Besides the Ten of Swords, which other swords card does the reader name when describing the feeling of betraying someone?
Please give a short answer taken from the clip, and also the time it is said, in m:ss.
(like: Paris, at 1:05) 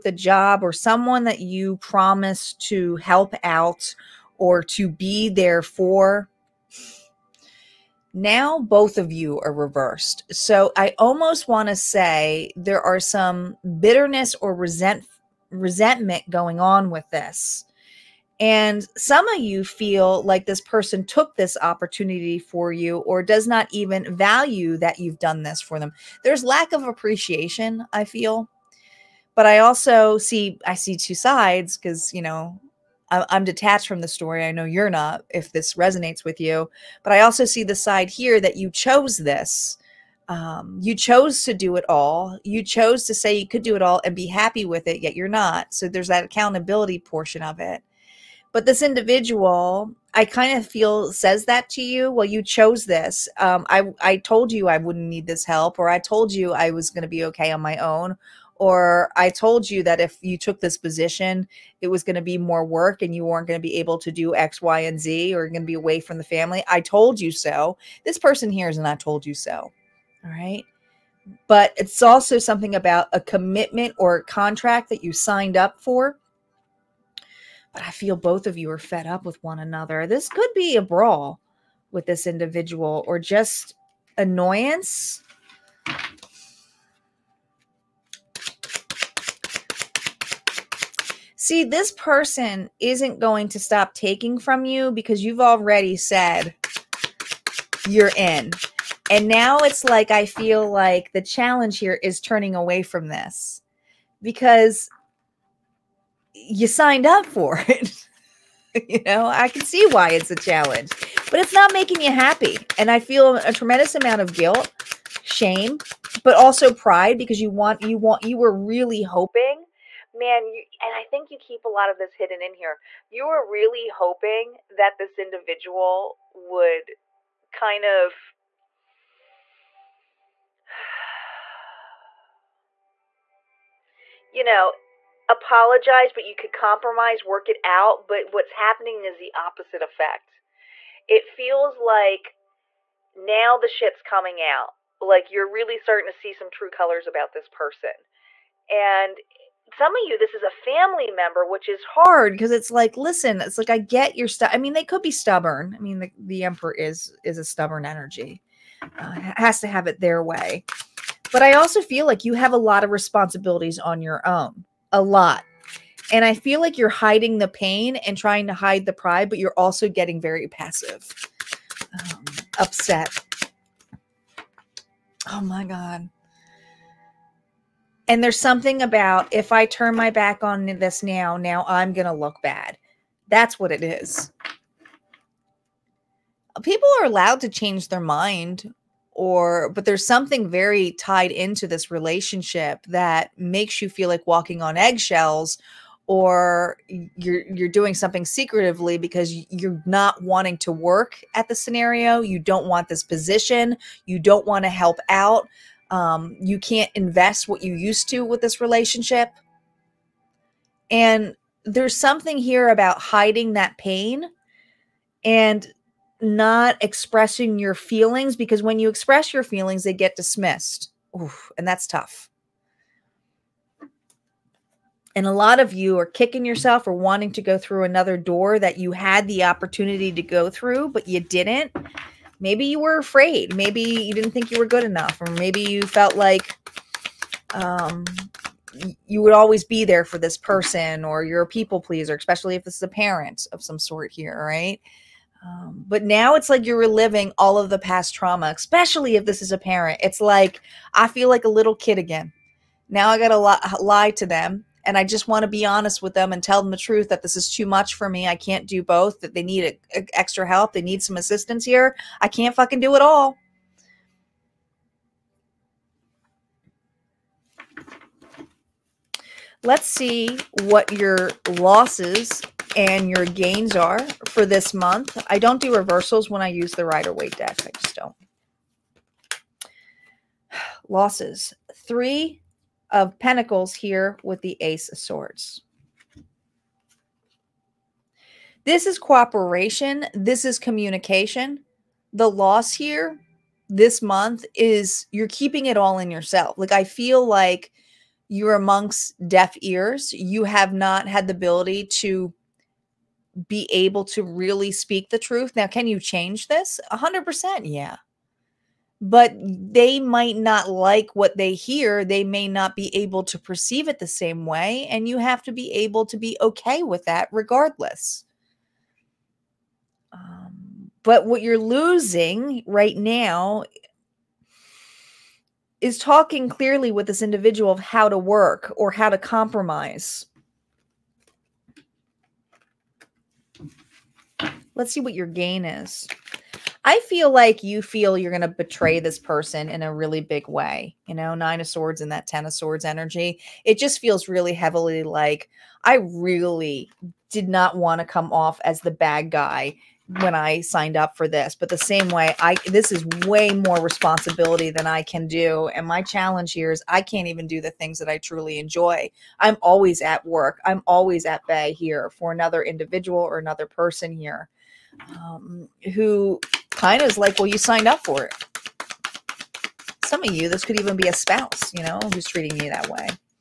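Nine of Swords, at 5:41.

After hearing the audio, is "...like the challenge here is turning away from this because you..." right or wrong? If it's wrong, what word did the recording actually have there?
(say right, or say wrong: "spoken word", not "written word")
right.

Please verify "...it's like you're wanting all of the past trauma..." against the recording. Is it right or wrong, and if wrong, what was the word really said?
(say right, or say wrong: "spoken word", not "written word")
wrong: "reliving", not "wanting".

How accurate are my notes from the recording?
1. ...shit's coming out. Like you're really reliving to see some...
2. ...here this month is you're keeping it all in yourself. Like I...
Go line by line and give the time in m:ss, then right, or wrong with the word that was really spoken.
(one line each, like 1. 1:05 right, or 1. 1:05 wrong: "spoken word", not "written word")
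1. 2:23 wrong: "starting", not "reliving"
2. 4:52 right.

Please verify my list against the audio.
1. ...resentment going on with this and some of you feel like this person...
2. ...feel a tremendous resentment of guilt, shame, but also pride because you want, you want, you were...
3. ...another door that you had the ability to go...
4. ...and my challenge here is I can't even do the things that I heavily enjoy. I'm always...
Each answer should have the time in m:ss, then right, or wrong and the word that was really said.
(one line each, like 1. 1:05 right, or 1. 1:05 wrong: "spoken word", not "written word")
1. 0:15 right
2. 1:52 wrong: "amount", not "resentment"
3. 3:47 wrong: "opportunity", not "ability"
4. 5:55 wrong: "truly", not "heavily".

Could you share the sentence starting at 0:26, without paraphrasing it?
There's lack of appreciation, I feel.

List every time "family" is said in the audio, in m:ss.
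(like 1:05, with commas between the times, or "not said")
1:06, 2:30.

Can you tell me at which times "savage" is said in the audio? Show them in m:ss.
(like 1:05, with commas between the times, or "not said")
not said.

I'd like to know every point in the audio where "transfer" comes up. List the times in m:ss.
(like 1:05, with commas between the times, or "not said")
not said.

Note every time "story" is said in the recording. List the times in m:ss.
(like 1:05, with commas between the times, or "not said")
0:34.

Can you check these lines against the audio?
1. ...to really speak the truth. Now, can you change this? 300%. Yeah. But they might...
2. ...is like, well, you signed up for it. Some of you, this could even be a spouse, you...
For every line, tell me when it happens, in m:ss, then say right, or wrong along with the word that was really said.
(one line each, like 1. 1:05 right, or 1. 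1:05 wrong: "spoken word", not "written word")
1. 5:04 wrong: "100", not "300"
2. 6:07 right.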